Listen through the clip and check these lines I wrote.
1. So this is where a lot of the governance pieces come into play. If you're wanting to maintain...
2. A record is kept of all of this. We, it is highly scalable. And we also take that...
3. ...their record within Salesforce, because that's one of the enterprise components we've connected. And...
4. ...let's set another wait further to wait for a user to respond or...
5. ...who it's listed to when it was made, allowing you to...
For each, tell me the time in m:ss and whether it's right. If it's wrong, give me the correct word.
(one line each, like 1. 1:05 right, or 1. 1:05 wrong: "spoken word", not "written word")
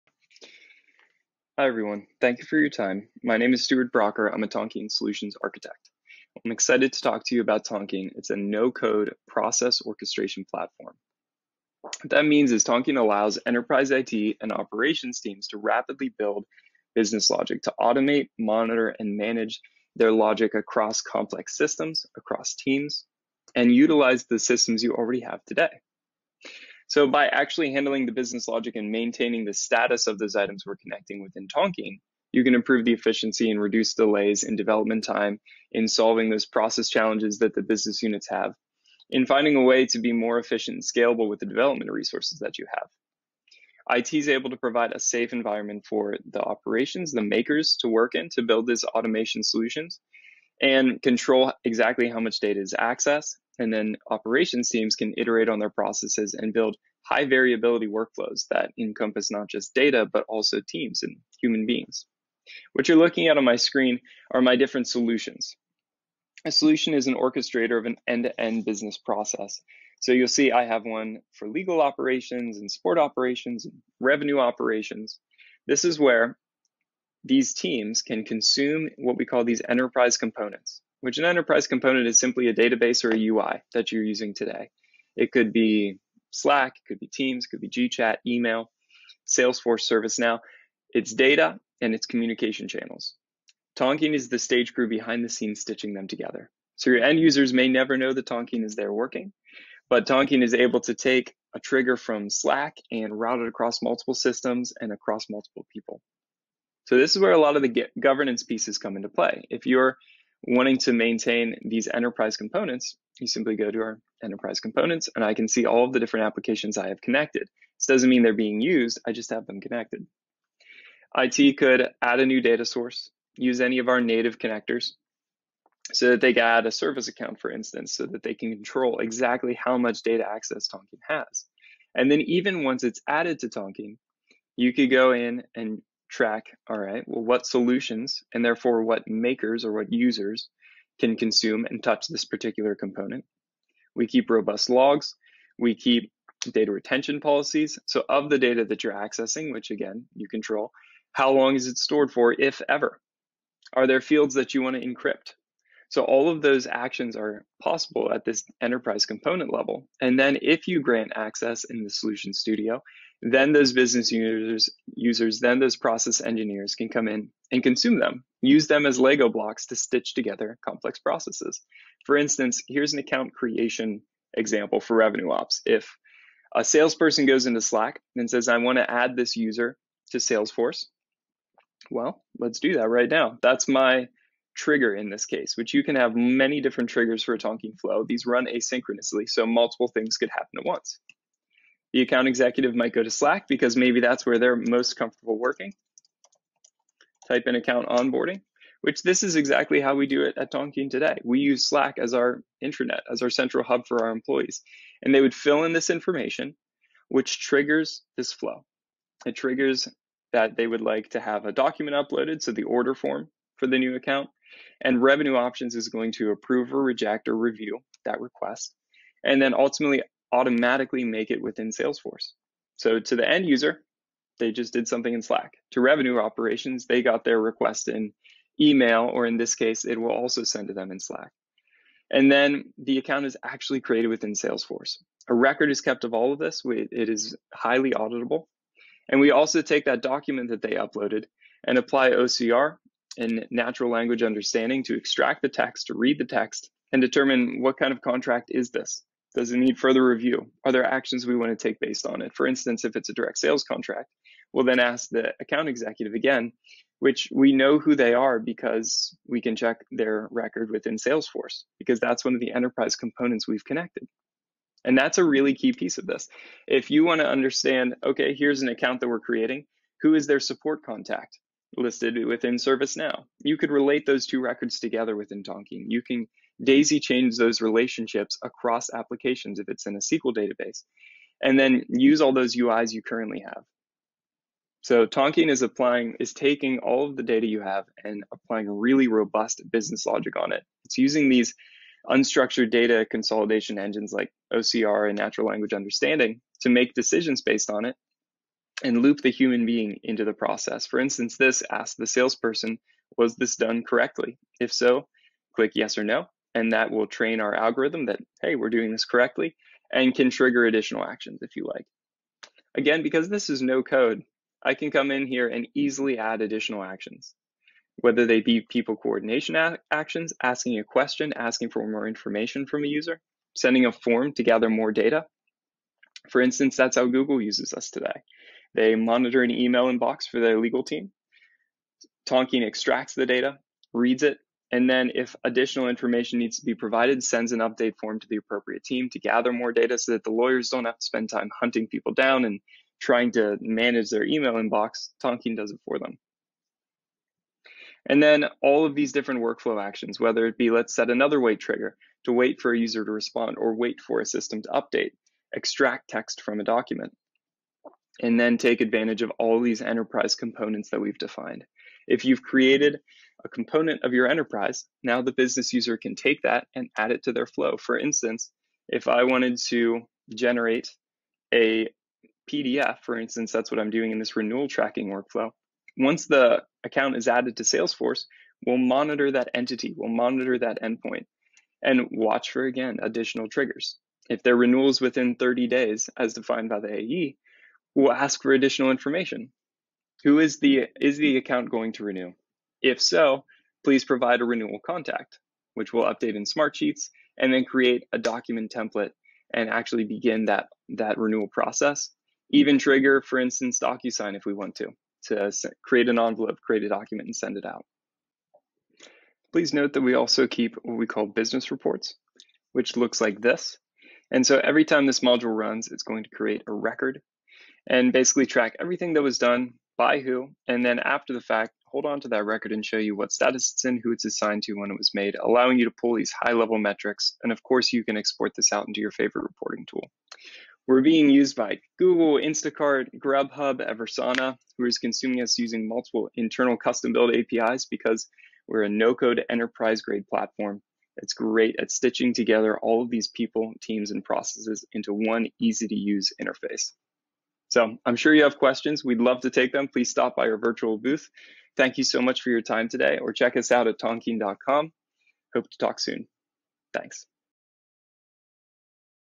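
1. 1:46 right
2. 3:55 wrong: "auditable", not "scalable"
3. 4:19 right
4. 5:50 wrong: "trigger", not "further"
5. 7:04 wrong: "assigned", not "listed".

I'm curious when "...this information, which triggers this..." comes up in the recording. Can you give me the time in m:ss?
3:25.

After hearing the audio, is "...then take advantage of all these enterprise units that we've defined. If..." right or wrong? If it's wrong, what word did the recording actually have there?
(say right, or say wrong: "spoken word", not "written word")
wrong: "components", not "units".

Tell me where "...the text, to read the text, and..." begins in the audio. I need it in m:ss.
4:05.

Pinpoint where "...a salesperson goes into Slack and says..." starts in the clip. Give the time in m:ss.
2:56.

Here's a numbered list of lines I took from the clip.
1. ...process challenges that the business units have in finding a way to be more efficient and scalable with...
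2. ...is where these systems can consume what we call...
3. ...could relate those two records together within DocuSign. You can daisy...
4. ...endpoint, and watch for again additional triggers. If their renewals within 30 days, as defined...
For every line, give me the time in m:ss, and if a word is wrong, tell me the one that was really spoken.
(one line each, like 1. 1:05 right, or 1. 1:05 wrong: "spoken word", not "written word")
1. 0:36 right
2. 1:15 wrong: "teams", not "systems"
3. 4:33 wrong: "Tonkean", not "DocuSign"
4. 6:20 right.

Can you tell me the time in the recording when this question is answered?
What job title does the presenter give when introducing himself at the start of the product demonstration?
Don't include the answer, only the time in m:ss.
0:04.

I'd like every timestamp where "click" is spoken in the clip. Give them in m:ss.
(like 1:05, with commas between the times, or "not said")
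5:05.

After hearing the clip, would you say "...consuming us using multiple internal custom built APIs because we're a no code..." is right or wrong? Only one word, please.
right.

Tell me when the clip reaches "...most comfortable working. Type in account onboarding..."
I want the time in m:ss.
3:14.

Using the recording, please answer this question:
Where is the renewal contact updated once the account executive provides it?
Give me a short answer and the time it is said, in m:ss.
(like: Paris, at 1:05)
Smartsheets, at 6:36.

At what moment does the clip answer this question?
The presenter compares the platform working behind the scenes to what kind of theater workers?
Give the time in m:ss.
1:34.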